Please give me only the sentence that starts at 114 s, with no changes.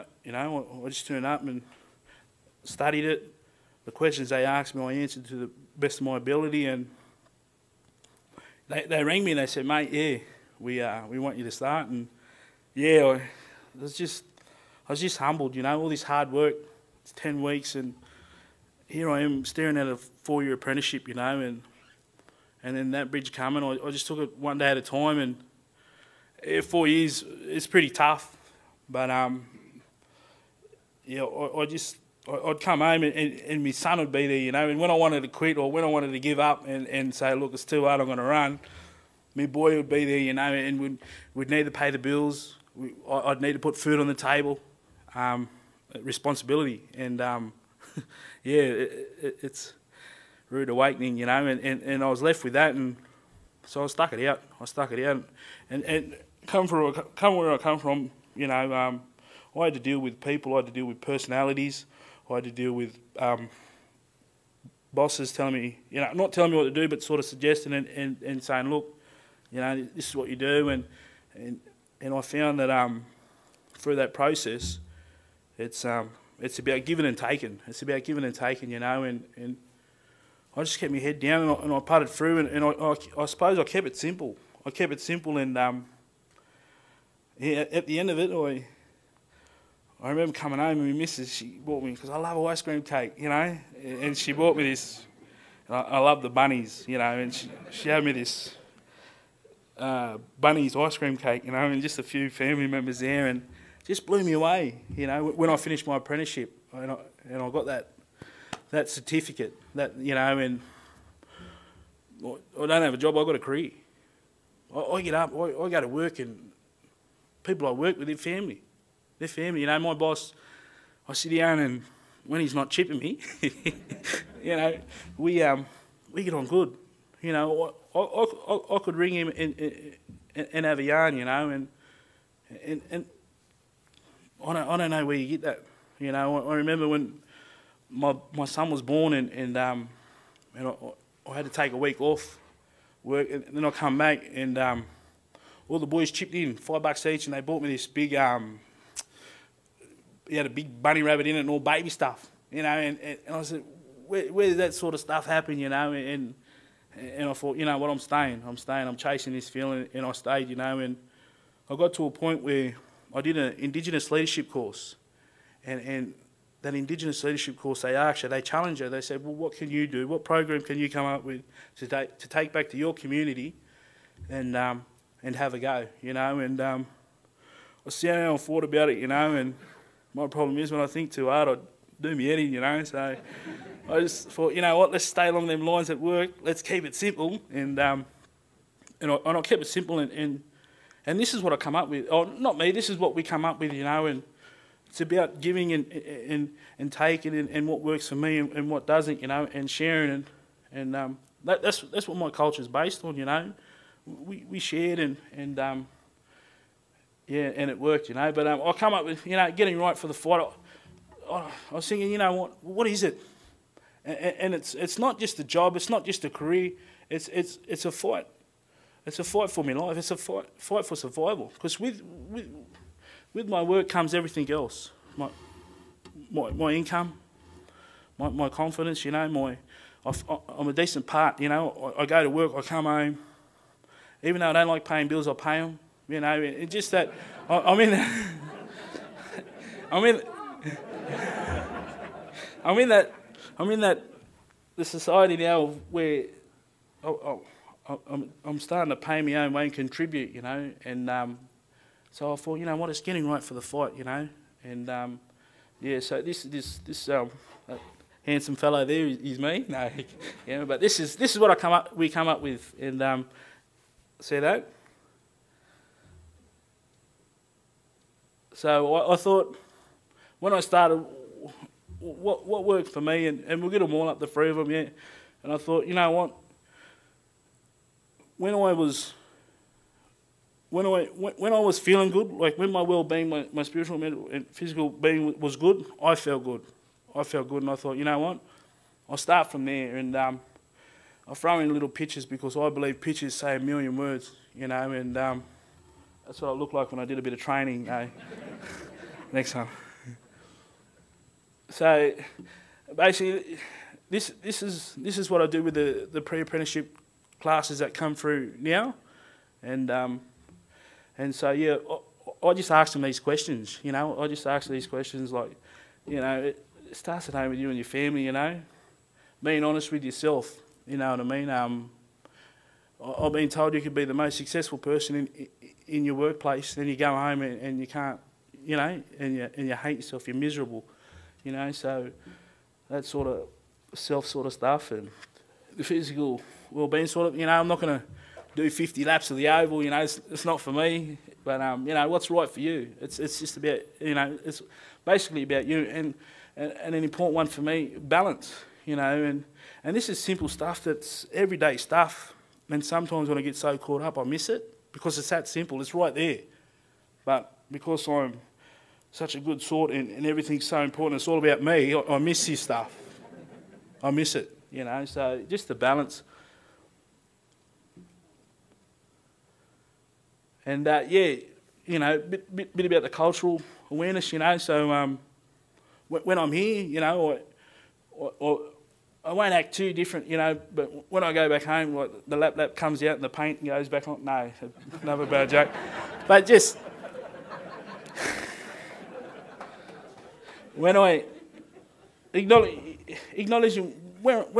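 I, I get up, I, I go to work, and people I work with in family.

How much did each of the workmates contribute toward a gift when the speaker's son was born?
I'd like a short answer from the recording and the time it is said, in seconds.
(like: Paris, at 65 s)
5 bucks, at 146 s.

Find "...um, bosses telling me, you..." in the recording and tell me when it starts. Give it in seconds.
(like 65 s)
63 s.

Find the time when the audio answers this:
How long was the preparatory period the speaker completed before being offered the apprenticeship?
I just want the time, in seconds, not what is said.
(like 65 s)
17 s.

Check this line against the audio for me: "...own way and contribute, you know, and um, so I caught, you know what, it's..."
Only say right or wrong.
wrong.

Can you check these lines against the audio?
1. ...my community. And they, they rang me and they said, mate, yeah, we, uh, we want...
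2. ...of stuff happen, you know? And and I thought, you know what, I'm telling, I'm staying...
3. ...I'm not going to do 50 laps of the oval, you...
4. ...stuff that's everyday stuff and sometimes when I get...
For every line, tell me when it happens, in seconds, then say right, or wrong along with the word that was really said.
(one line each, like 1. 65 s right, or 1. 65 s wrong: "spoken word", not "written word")
1. 6 s wrong: "ability", not "community"
2. 154 s wrong: "staying", not "telling"
3. 337 s right
4. 350 s right.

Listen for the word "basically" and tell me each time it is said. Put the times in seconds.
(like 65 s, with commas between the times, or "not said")
302 s, 345 s.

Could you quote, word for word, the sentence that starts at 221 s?
Because with, with with my work comes everything else.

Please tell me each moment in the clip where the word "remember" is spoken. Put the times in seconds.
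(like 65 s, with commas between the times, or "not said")
90 s, 136 s.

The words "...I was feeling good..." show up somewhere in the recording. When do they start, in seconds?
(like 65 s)
281 s.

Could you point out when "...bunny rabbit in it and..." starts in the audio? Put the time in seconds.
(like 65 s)
150 s.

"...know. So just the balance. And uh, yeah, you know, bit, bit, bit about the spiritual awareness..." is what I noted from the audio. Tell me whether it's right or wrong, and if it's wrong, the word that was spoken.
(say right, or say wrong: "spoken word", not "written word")
wrong: "cultural", not "spiritual".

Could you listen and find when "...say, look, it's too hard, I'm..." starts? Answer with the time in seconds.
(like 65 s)
37 s.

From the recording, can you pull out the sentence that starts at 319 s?
Being honest with yourself, you know what I mean?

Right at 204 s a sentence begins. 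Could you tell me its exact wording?
We we shared, and and um, yeah, and it worked, you know.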